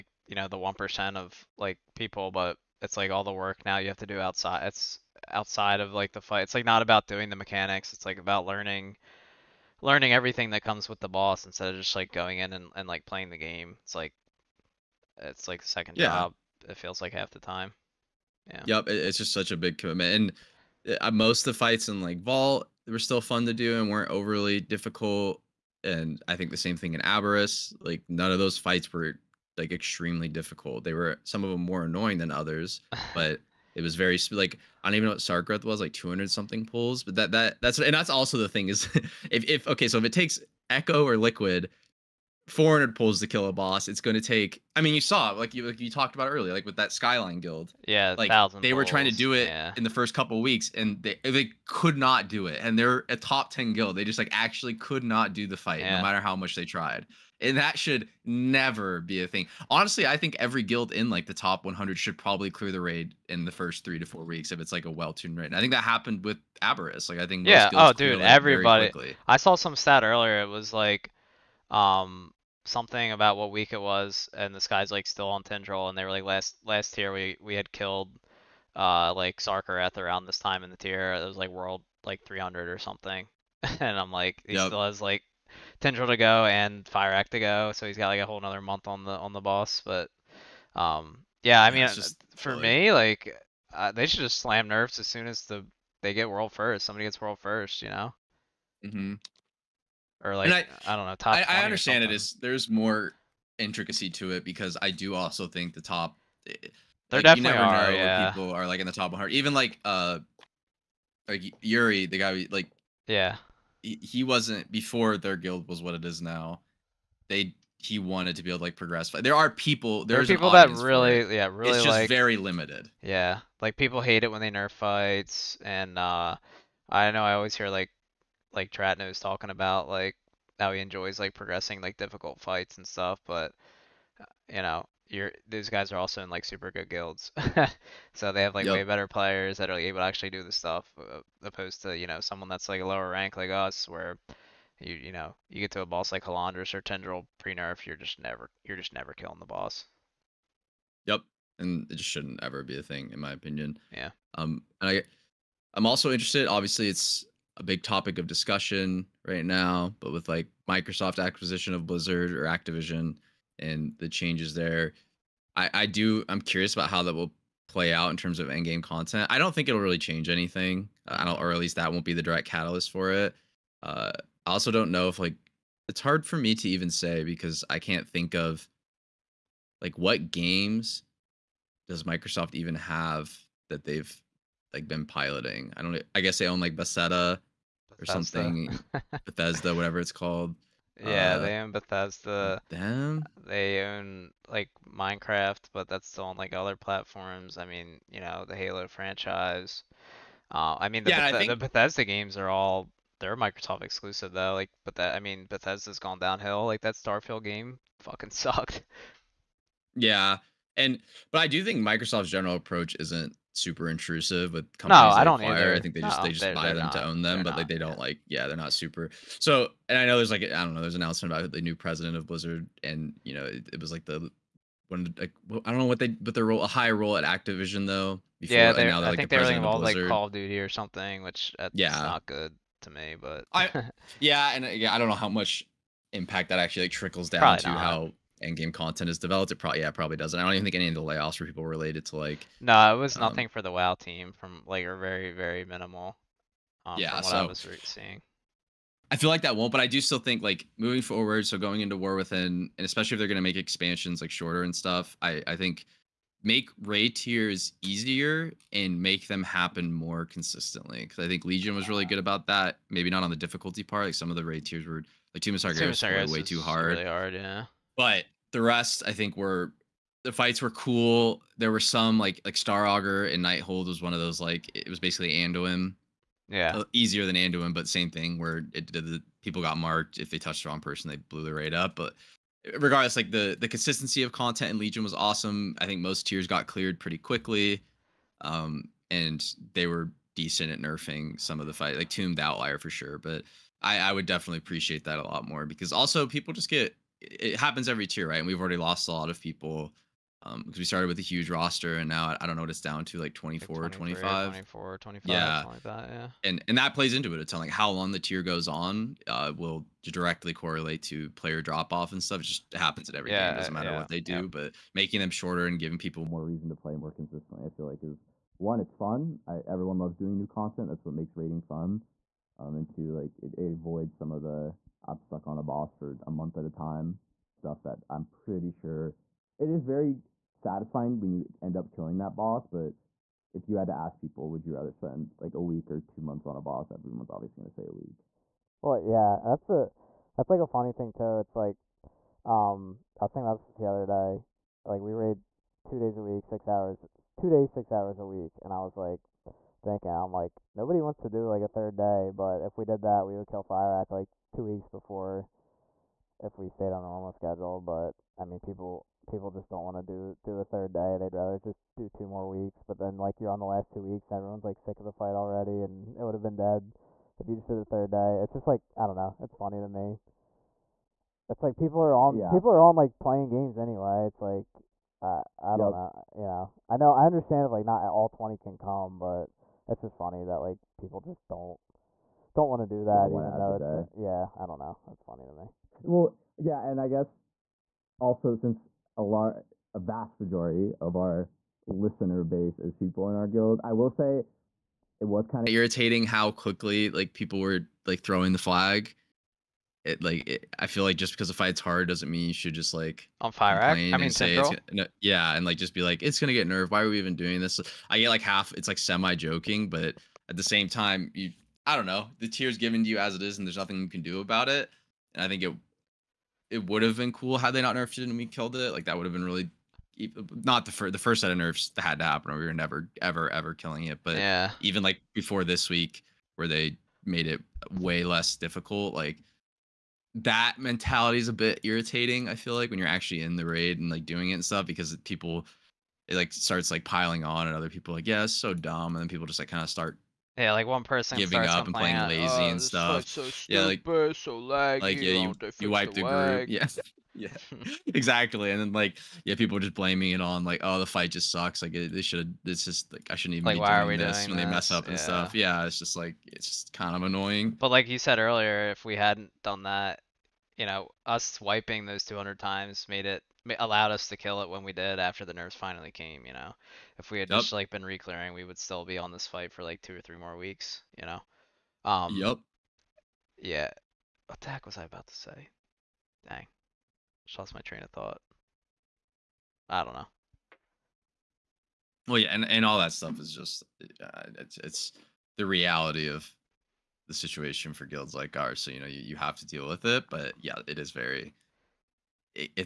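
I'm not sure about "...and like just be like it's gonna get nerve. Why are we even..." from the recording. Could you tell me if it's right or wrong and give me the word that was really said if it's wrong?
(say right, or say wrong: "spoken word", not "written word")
right.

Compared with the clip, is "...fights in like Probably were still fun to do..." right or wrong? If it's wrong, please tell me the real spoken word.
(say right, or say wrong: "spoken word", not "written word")
wrong: "Vault", not "Probably".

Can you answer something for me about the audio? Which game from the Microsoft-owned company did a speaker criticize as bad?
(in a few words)
Starfield.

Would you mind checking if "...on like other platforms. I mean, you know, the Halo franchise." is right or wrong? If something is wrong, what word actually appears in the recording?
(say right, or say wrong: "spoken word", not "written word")
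right.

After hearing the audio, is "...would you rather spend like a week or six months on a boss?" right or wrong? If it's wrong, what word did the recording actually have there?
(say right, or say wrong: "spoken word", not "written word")
wrong: "two", not "six".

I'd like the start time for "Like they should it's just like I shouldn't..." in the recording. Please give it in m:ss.
7:31.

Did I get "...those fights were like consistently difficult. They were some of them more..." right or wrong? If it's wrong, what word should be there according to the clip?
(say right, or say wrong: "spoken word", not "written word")
wrong: "extremely", not "consistently".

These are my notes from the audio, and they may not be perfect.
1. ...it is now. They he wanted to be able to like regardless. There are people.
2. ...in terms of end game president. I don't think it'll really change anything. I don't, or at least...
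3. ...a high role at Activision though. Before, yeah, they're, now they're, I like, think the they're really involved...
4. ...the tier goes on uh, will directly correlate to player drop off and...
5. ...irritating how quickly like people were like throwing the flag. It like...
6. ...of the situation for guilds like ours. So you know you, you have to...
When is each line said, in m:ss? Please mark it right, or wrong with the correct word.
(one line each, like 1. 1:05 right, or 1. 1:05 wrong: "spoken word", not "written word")
1. 1:55 wrong: "progress", not "regardless"
2. 2:48 wrong: "content", not "president"
3. 3:46 right
4. 5:08 right
5. 6:35 right
6. 8:06 right.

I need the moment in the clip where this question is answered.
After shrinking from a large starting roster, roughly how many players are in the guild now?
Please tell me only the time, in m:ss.
5:04.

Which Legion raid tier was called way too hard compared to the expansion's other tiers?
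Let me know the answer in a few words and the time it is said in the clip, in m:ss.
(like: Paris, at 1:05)
Tomb of Sargeras, at 4:25.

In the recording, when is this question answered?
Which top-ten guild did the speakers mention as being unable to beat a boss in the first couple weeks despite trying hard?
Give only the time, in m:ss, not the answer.
0:46.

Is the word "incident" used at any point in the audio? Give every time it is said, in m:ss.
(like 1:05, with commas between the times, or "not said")
not said.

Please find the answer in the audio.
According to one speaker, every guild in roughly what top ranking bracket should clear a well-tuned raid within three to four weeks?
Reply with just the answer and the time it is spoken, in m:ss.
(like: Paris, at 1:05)
Top 100, at 1:01.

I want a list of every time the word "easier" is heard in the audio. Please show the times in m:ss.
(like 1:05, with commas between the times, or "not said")
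4:17, 4:36.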